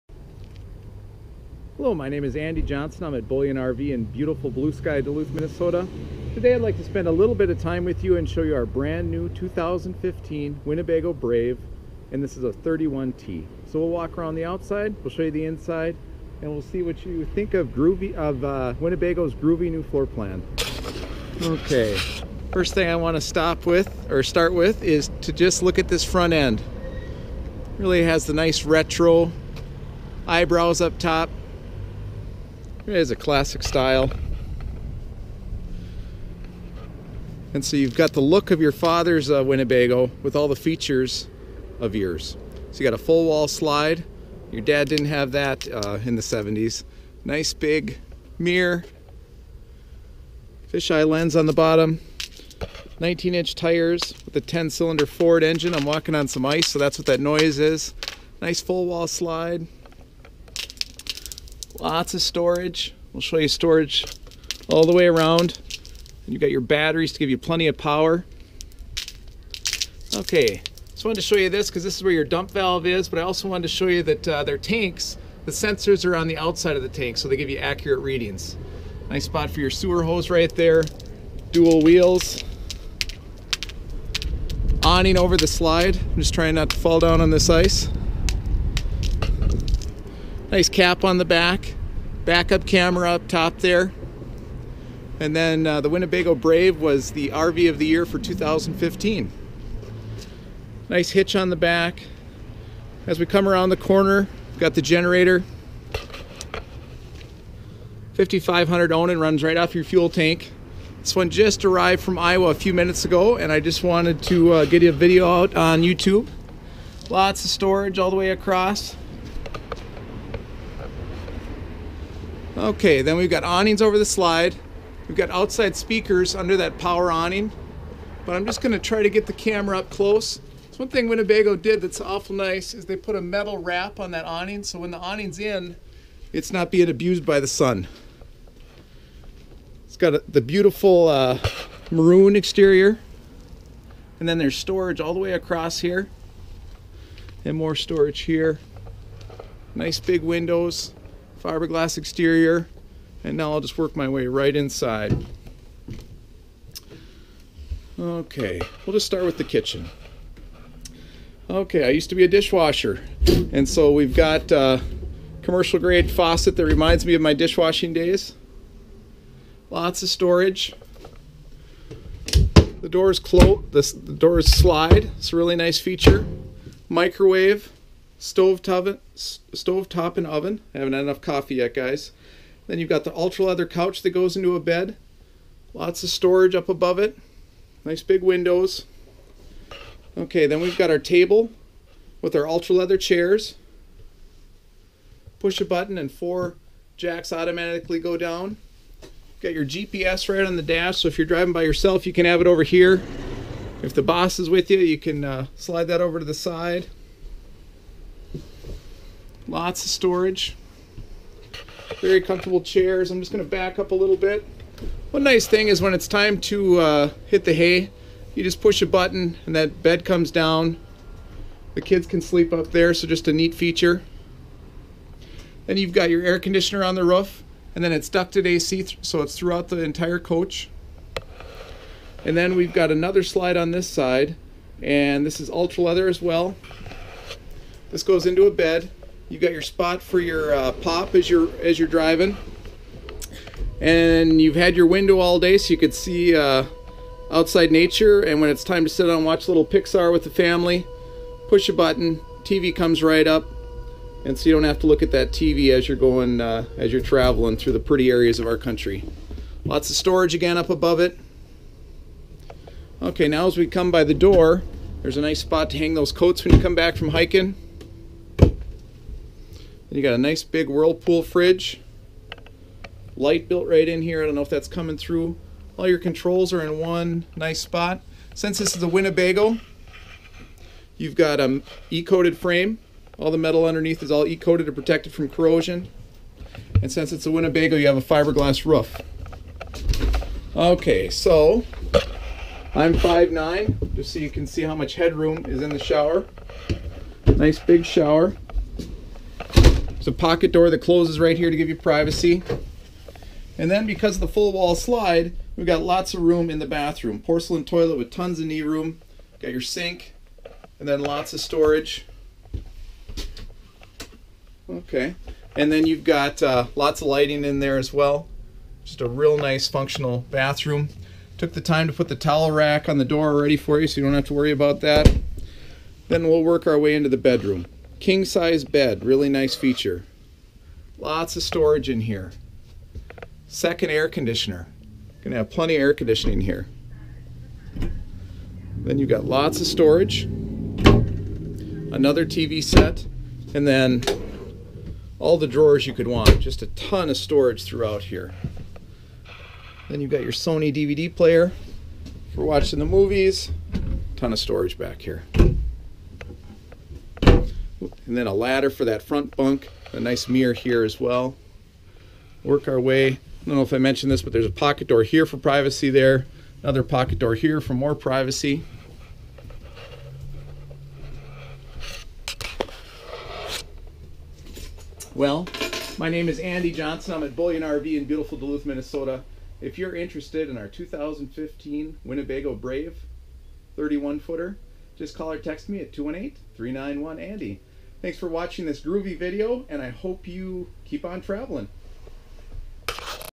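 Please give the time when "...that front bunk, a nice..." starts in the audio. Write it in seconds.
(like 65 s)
358 s.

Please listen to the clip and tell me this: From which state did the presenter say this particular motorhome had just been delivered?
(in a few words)
Iowa.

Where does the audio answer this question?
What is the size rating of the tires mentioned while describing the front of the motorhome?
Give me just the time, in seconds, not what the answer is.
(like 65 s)
52 s.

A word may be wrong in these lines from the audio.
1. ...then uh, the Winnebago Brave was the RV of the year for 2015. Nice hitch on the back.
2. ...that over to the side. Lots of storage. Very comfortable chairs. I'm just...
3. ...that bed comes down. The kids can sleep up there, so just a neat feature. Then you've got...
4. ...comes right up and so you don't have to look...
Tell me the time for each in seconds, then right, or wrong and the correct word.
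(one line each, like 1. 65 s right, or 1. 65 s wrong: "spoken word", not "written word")
1. 95 s right
2. 205 s right
3. 219 s right
4. 252 s right.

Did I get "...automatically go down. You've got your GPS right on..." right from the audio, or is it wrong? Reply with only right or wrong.
right.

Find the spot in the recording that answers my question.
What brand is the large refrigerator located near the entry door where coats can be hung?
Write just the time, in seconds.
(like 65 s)
270 s.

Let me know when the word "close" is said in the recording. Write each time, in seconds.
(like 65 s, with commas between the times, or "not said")
129 s, 173 s, 300 s.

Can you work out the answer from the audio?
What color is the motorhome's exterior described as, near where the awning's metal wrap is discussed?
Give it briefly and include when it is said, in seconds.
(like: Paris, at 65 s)
Maroon, at 141 s.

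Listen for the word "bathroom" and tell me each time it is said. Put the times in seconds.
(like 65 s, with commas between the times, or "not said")
306 s, 320 s.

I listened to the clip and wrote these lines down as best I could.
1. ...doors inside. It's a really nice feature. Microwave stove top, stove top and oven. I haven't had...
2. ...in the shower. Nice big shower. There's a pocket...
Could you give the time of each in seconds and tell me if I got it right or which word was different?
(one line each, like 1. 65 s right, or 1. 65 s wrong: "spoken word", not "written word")
1. 174 s wrong: "slide", not "inside"
2. 295 s right.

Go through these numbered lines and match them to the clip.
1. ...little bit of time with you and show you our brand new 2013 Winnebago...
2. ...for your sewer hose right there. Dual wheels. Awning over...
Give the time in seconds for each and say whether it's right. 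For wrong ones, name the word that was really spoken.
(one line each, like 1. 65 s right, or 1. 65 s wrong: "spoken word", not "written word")
1. 7 s wrong: "2015", not "2013"
2. 79 s right.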